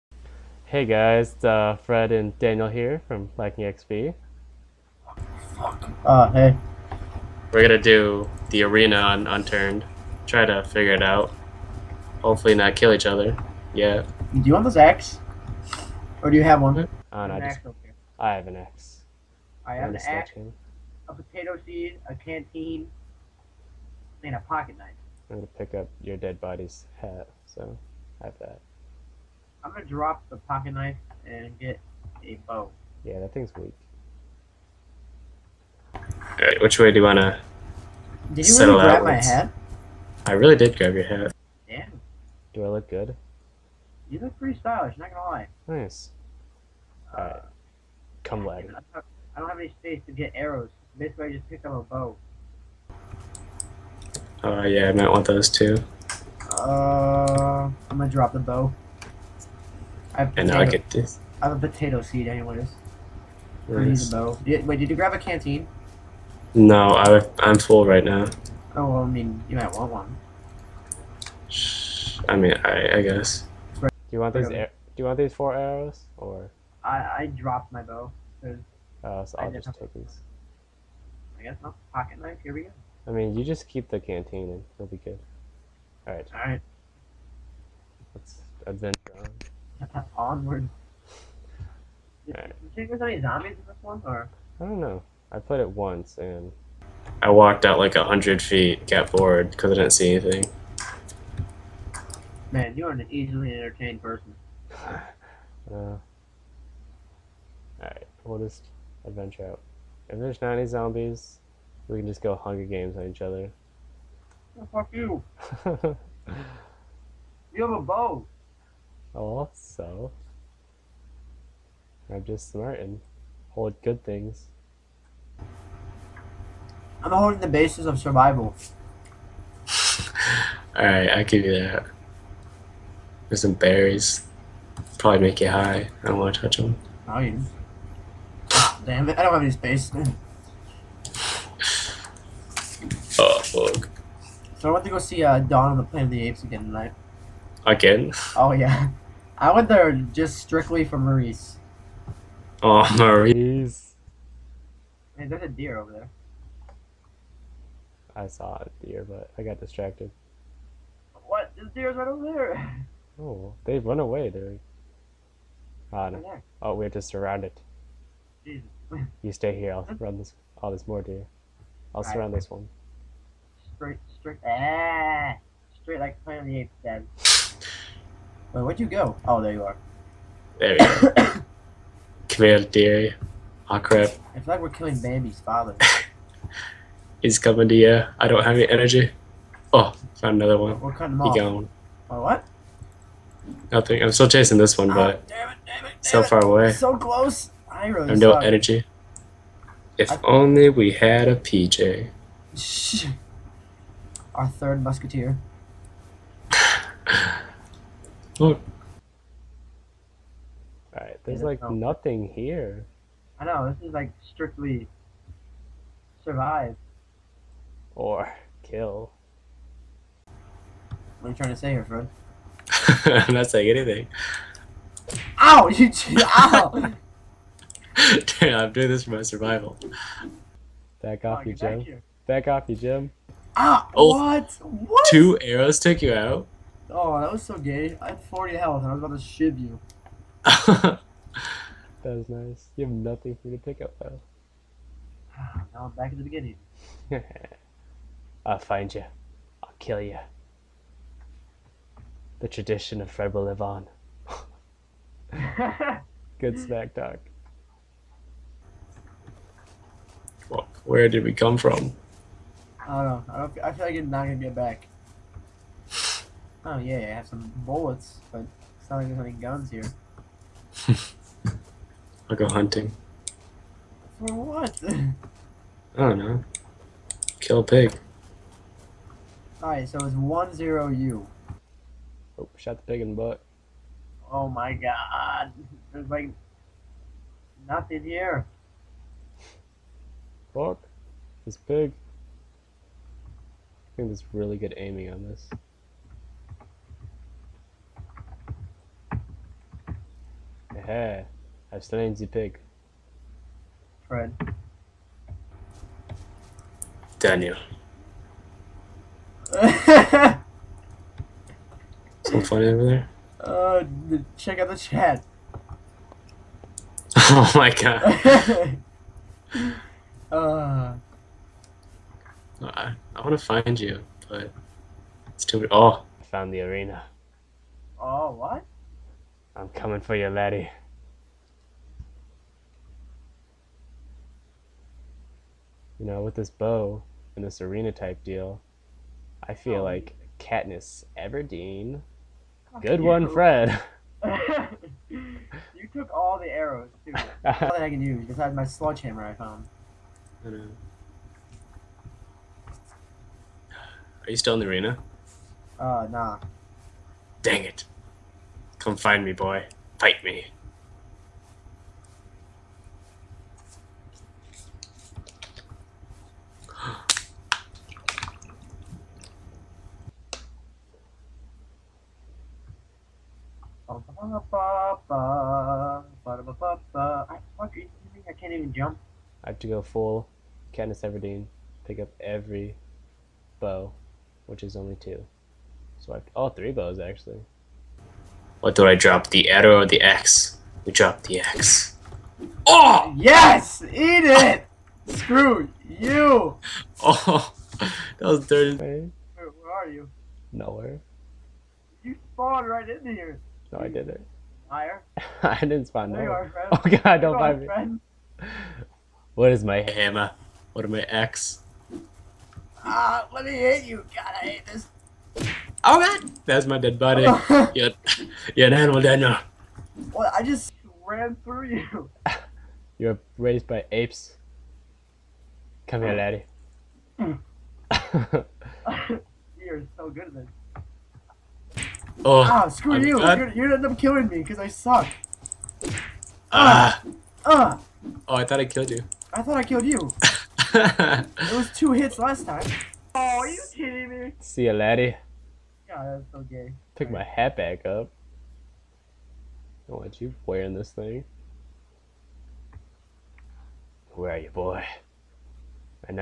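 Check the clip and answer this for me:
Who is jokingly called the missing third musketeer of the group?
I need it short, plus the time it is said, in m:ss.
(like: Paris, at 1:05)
PJ, at 3:21.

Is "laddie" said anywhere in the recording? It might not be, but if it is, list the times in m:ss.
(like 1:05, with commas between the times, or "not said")
5:30, 7:06, 7:24.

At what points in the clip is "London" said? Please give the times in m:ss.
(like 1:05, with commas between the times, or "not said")
not said.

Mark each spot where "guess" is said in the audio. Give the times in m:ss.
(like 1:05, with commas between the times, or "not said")
1:13, 1:21.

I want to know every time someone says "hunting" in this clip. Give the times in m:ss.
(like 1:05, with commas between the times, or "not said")
4:32.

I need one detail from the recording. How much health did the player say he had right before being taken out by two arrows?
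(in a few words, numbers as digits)
40.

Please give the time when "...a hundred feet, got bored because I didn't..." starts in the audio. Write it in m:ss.
1:37.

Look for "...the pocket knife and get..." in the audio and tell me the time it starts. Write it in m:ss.
0:30.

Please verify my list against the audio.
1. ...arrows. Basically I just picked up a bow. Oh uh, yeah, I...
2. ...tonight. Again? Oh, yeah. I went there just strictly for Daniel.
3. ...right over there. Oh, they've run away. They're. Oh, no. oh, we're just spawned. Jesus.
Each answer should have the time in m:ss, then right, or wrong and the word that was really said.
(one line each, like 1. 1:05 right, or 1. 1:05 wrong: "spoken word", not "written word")
1. 0:50 right
2. 2:26 wrong: "Maurice", not "Daniel"
3. 2:41 wrong: "surrounded", not "spawned".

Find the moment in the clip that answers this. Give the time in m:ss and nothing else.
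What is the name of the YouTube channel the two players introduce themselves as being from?
0:03.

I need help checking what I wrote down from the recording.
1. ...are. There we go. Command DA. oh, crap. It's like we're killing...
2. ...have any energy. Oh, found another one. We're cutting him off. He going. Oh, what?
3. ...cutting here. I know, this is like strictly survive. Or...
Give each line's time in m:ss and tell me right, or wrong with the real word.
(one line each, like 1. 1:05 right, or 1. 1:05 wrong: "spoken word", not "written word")
1. 2:59 right
2. 3:08 right
3. 3:31 wrong: "nothing", not "cutting".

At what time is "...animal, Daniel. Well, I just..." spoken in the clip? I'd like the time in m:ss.
6:58.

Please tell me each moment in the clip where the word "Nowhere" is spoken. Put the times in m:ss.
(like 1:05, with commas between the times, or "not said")
6:40, 6:46.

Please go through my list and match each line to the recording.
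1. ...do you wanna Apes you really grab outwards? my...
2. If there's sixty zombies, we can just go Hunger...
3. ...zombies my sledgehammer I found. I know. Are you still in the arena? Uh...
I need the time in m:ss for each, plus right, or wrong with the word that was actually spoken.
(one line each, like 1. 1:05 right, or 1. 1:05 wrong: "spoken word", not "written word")
1. 0:36 wrong: "Did", not "Apes"
2. 1:50 wrong: "ninety", not "sixty"
3. 5:48 wrong: "besides", not "zombies".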